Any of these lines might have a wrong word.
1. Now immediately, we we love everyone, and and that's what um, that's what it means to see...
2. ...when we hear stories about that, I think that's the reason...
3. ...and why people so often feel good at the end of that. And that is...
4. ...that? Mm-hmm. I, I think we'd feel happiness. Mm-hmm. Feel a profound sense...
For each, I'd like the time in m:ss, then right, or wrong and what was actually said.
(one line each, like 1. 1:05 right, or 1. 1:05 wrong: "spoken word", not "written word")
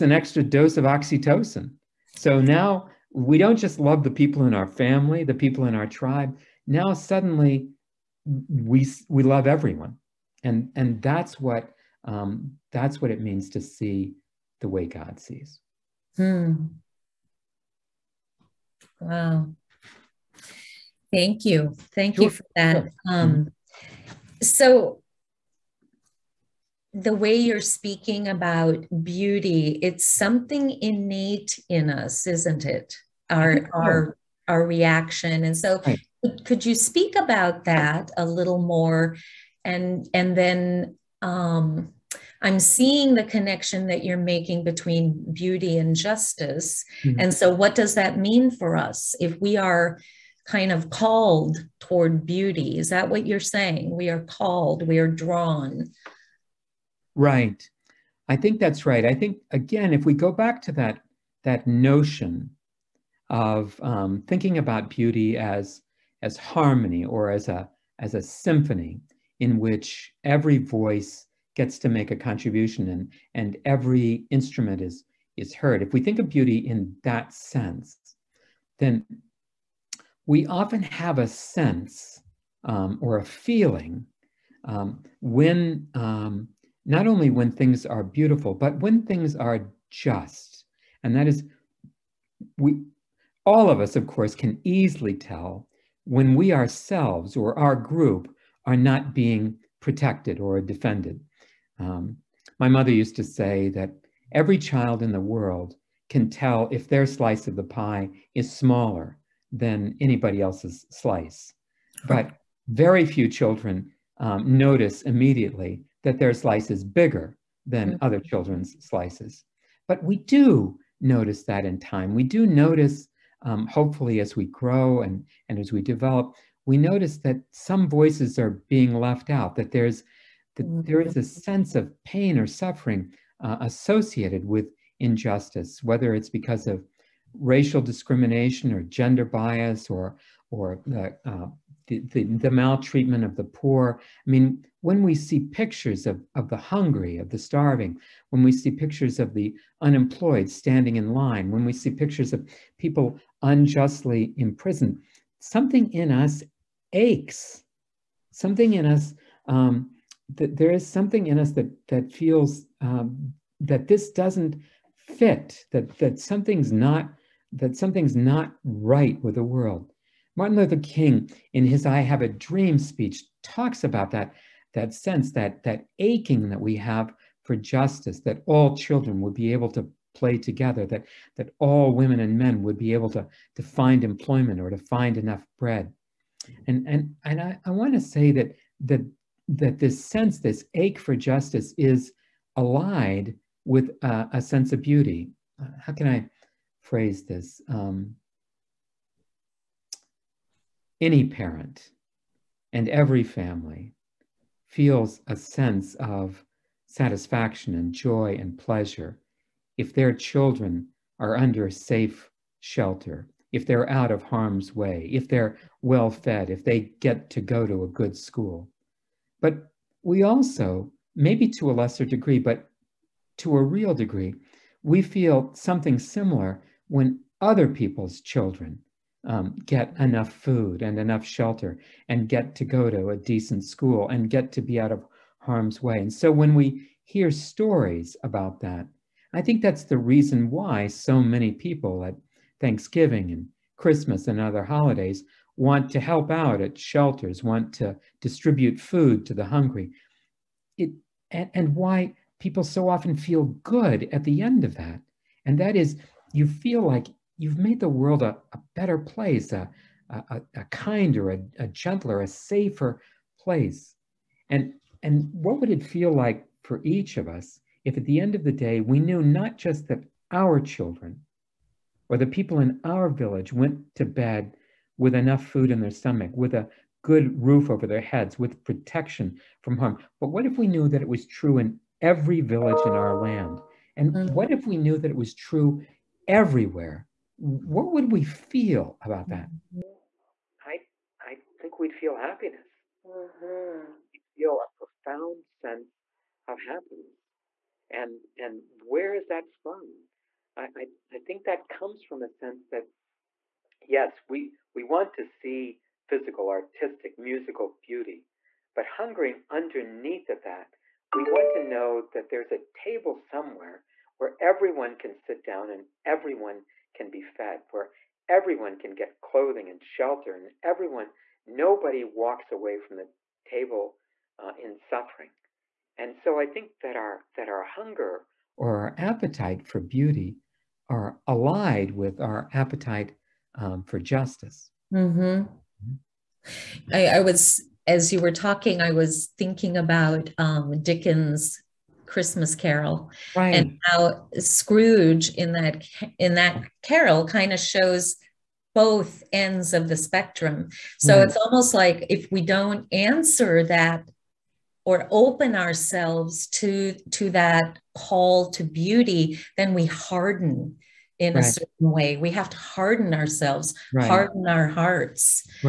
1. 0:06 wrong: "suddenly", not "immediately"
2. 3:56 right
3. 4:11 right
4. 4:49 right.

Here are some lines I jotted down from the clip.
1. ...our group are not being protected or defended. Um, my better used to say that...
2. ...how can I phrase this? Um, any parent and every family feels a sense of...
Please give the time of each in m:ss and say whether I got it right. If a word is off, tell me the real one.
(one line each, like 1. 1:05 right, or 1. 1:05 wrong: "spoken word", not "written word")
1. 1:37 wrong: "mother", not "better"
2. 3:15 right.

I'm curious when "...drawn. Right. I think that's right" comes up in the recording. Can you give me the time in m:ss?
0:55.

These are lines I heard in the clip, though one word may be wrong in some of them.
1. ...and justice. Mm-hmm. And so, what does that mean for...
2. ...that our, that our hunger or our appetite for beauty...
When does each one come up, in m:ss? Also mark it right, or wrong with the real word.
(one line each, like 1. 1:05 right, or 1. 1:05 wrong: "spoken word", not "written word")
1. 0:45 right
2. 5:26 right.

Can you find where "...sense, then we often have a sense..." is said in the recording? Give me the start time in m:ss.
1:17.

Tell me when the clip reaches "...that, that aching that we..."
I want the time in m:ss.
2:55.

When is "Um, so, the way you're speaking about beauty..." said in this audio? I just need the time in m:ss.
0:23.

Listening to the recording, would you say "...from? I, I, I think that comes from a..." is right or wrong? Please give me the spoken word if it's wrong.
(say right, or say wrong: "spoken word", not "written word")
right.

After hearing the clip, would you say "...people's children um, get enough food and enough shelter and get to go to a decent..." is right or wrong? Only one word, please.
right.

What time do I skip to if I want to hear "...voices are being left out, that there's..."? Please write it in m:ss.
2:07.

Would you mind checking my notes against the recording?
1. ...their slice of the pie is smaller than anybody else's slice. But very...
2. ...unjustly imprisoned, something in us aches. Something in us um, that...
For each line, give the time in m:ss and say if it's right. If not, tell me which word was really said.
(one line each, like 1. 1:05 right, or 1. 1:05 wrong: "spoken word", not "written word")
1. 1:46 right
2. 2:33 right.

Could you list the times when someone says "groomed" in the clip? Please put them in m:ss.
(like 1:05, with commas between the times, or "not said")
not said.